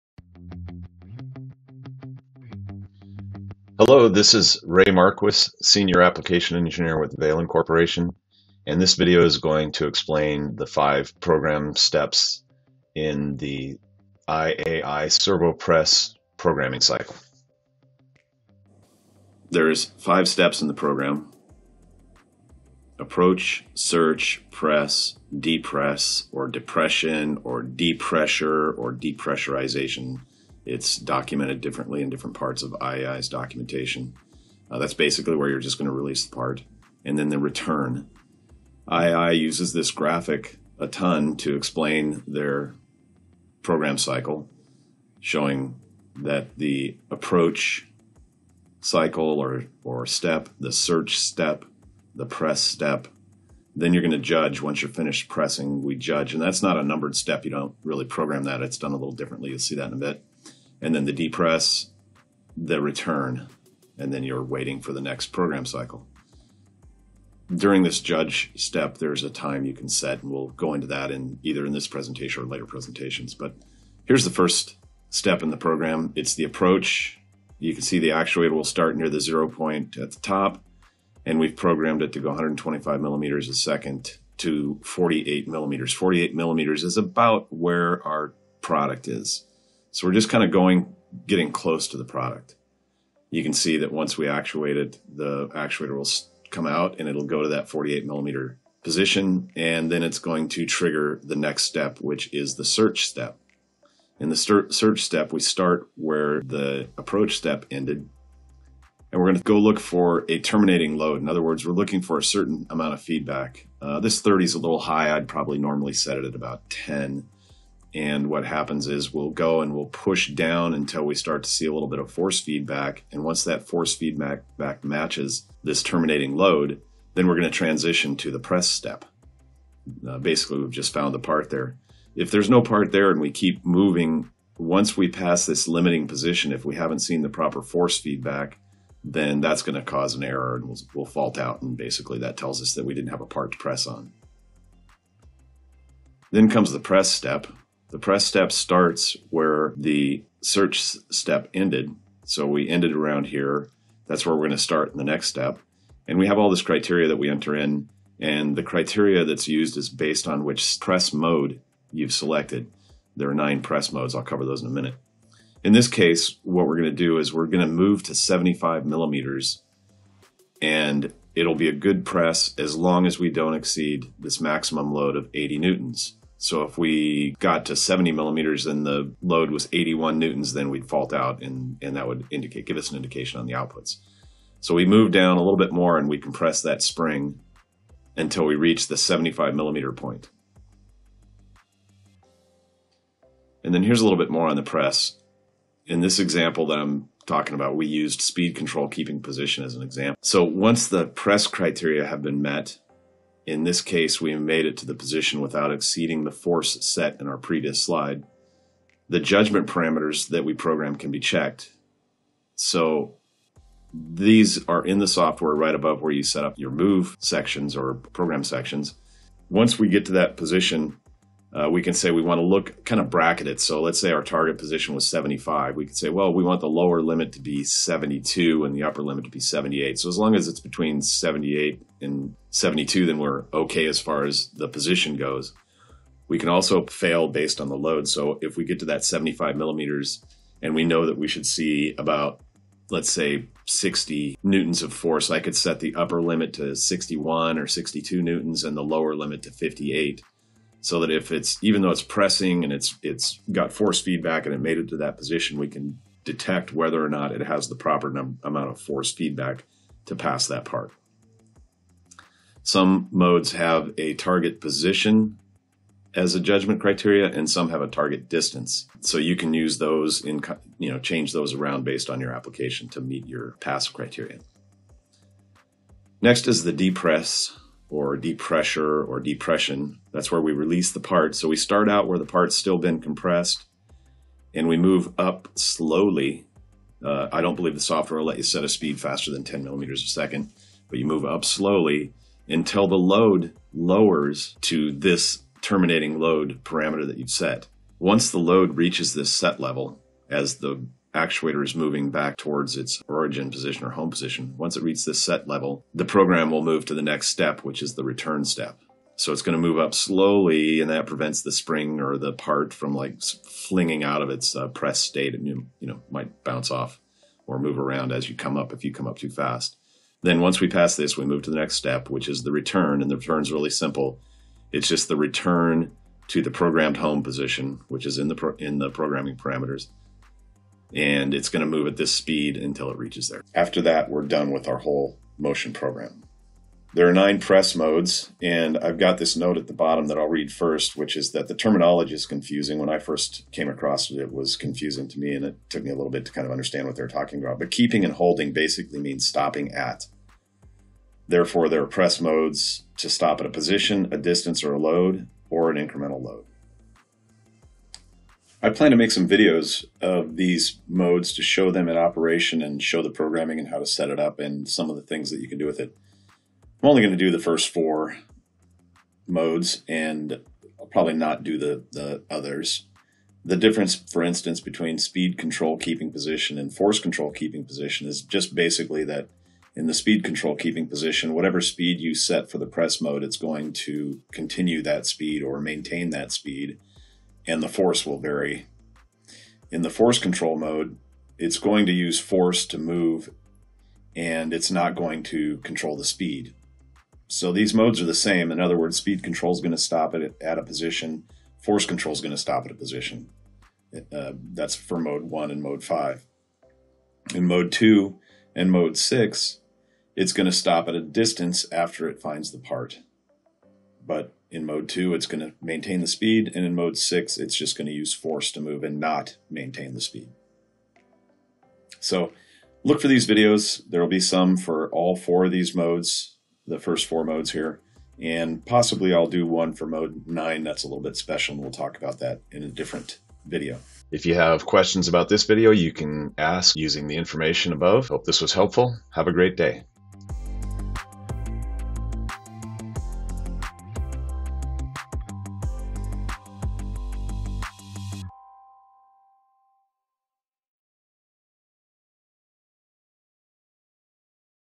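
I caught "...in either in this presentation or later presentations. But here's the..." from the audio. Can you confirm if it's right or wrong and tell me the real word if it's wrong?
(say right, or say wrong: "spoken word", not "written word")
right.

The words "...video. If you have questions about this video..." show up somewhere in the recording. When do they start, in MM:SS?
07:13.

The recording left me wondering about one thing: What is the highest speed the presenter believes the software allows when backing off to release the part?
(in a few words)
10 millimeters a second.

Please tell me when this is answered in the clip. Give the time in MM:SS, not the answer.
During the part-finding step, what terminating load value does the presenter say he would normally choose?
01:56.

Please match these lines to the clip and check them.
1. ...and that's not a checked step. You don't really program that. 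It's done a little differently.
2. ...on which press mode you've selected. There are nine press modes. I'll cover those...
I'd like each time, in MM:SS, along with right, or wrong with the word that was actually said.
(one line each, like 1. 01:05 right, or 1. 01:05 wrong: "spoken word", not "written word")
1. 00:56 wrong: "numbered", not "checked"
2. 02:40 right.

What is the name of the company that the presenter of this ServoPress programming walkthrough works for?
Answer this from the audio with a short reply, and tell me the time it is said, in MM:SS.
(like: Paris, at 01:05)
Valin Corporation, at 00:07.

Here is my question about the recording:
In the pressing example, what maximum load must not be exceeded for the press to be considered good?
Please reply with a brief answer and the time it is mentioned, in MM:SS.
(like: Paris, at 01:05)
80 newtons, at 02:55.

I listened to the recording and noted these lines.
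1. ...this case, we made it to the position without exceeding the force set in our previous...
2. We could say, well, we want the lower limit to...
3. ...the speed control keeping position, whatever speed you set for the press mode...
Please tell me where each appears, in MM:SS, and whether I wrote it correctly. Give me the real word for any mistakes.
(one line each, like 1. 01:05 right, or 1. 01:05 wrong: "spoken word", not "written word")
1. 03:23 right
2. 03:45 right
3. 06:19 right.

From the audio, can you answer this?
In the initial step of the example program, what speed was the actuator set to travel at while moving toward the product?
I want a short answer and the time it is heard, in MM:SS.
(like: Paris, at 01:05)
125 millimeters a second, at 01:22.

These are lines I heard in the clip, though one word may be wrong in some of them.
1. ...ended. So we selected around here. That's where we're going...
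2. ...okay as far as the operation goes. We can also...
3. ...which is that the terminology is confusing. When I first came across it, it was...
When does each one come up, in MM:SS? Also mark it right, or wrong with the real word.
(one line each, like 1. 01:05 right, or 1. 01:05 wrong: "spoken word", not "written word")
1. 02:31 wrong: "ended", not "selected"
2. 03:53 wrong: "position", not "operation"
3. 05:40 right.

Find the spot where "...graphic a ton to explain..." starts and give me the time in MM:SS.
00:39.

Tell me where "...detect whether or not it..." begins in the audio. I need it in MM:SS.
04:16.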